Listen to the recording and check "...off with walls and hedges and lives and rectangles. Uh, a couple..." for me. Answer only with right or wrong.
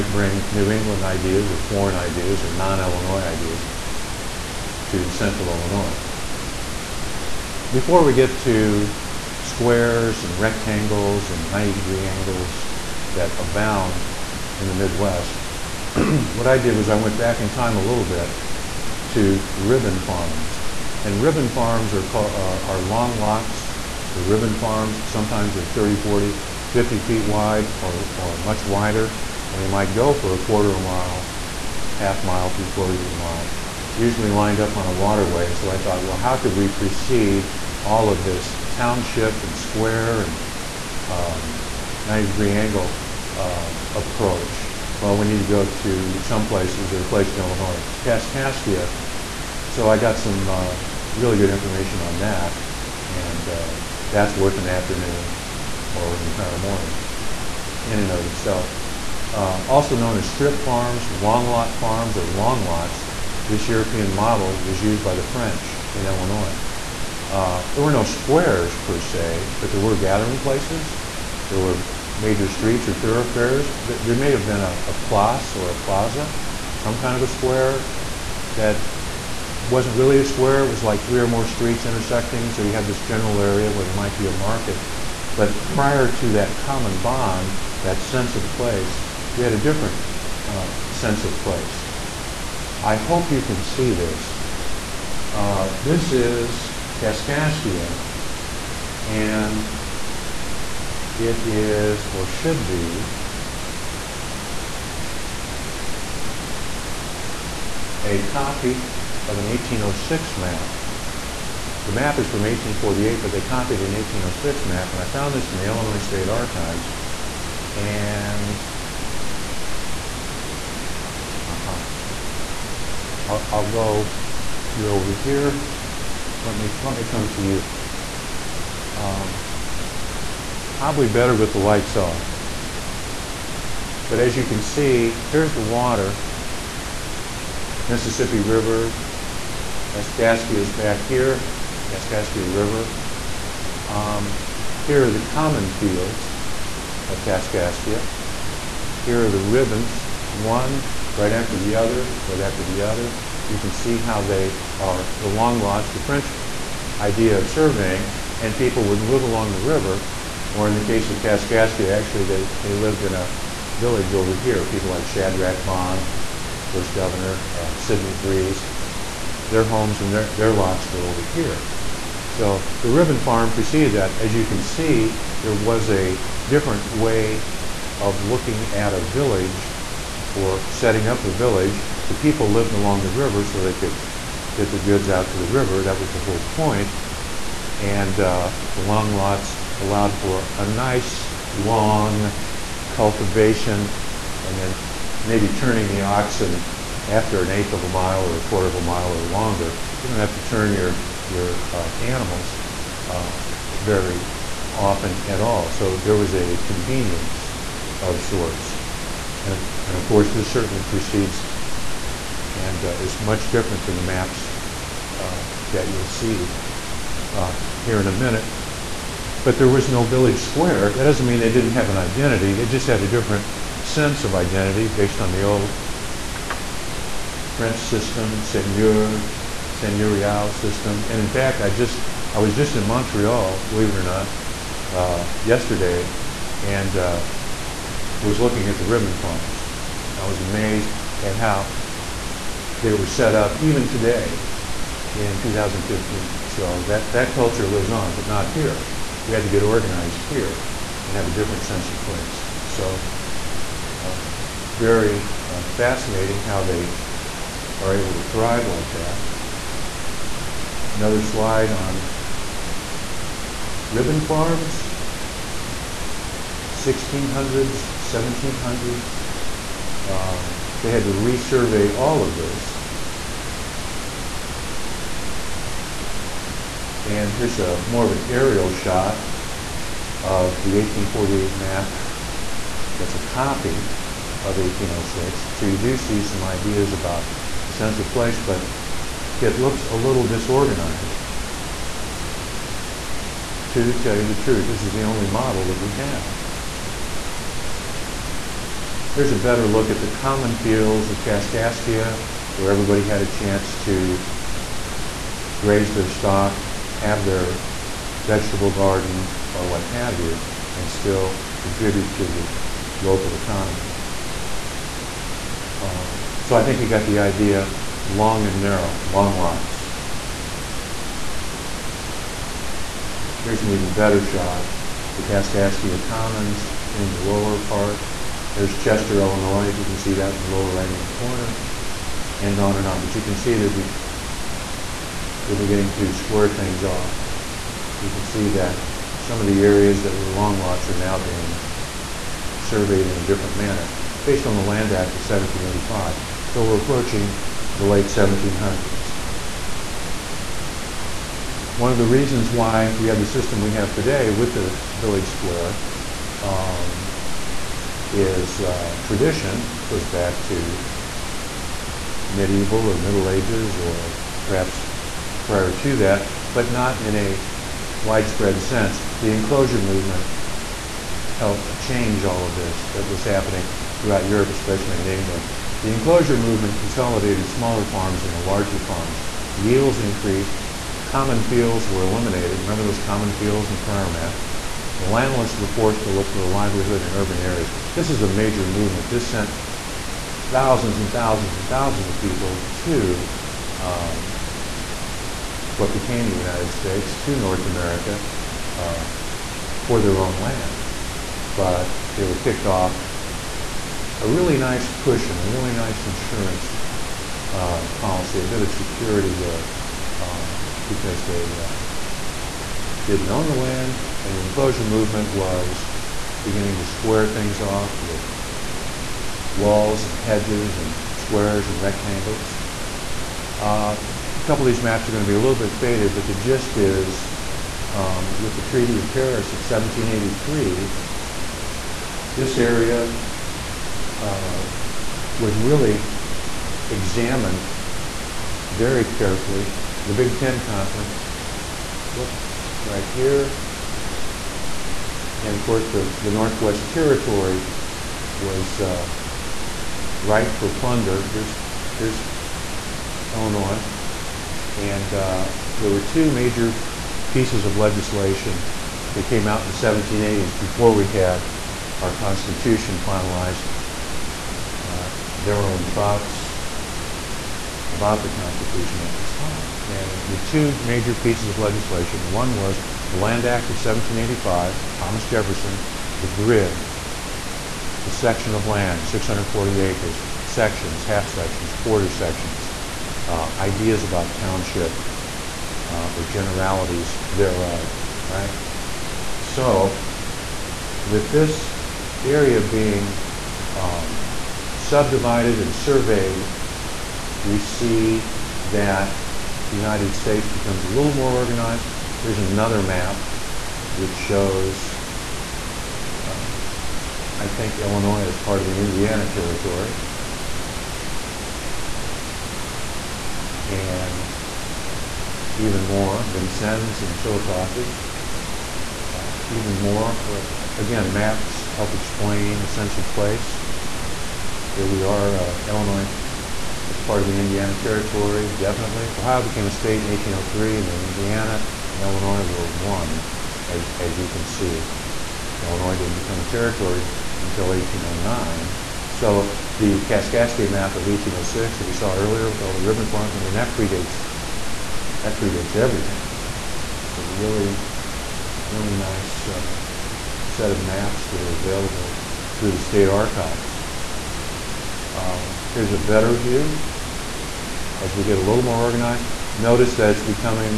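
wrong.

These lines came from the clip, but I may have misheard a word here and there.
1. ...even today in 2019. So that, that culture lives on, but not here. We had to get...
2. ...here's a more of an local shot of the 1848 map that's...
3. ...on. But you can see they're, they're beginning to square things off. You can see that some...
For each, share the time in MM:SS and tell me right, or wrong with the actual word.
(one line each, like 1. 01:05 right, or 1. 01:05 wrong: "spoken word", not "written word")
1. 04:03 wrong: "2015", not "2019"
2. 04:37 wrong: "aerial", not "local"
3. 05:32 right.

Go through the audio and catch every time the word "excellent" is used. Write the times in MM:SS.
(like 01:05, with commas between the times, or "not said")
not said.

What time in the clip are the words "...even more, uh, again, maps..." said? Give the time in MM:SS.
08:39.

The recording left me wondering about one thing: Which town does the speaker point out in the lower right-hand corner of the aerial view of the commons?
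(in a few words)
Chester, Illinois.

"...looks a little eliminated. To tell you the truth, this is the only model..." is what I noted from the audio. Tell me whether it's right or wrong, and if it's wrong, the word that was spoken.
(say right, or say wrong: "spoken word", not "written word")
wrong: "disorganized", not "eliminated".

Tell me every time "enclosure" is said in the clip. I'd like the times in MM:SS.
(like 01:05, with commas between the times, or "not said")
06:09, 06:15, 06:54.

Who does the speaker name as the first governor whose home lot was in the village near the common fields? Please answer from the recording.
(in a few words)
Shadrach Bond.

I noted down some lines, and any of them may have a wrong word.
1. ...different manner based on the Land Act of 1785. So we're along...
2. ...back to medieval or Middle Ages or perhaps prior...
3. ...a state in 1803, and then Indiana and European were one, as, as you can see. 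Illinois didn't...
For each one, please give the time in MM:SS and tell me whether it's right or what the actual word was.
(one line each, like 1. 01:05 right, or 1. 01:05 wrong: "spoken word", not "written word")
1. 05:43 wrong: "approaching", not "along"
2. 06:00 right
3. 08:49 wrong: "Illinois", not "European".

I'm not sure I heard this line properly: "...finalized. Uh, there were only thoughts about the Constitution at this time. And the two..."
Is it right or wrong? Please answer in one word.
right.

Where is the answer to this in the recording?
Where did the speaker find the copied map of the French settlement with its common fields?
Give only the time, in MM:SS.
01:55.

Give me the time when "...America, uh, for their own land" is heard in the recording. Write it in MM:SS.
06:37.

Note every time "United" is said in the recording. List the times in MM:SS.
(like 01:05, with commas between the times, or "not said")
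06:36, 08:19.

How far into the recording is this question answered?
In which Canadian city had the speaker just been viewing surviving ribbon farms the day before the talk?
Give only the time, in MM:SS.
03:52.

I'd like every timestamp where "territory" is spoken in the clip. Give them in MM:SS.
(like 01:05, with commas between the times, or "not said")
07:26, 08:29, 08:47, 08:56.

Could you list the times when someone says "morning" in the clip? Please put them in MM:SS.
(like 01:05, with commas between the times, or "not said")
00:56.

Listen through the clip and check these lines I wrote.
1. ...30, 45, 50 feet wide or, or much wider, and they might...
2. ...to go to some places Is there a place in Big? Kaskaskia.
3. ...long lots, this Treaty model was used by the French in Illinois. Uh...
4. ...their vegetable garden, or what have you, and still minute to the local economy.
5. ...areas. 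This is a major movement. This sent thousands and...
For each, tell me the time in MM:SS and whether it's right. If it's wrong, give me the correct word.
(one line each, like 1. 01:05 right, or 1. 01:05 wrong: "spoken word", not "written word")
1. 00:25 wrong: "40", not "45"
2. 00:45 wrong: "Illinois", not "Big"
3. 01:02 wrong: "European", not "Treaty"
4. 05:07 wrong: "contribute", not "minute"
5. 06:27 right.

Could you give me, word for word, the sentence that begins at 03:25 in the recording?
So there was a convenience of sorts.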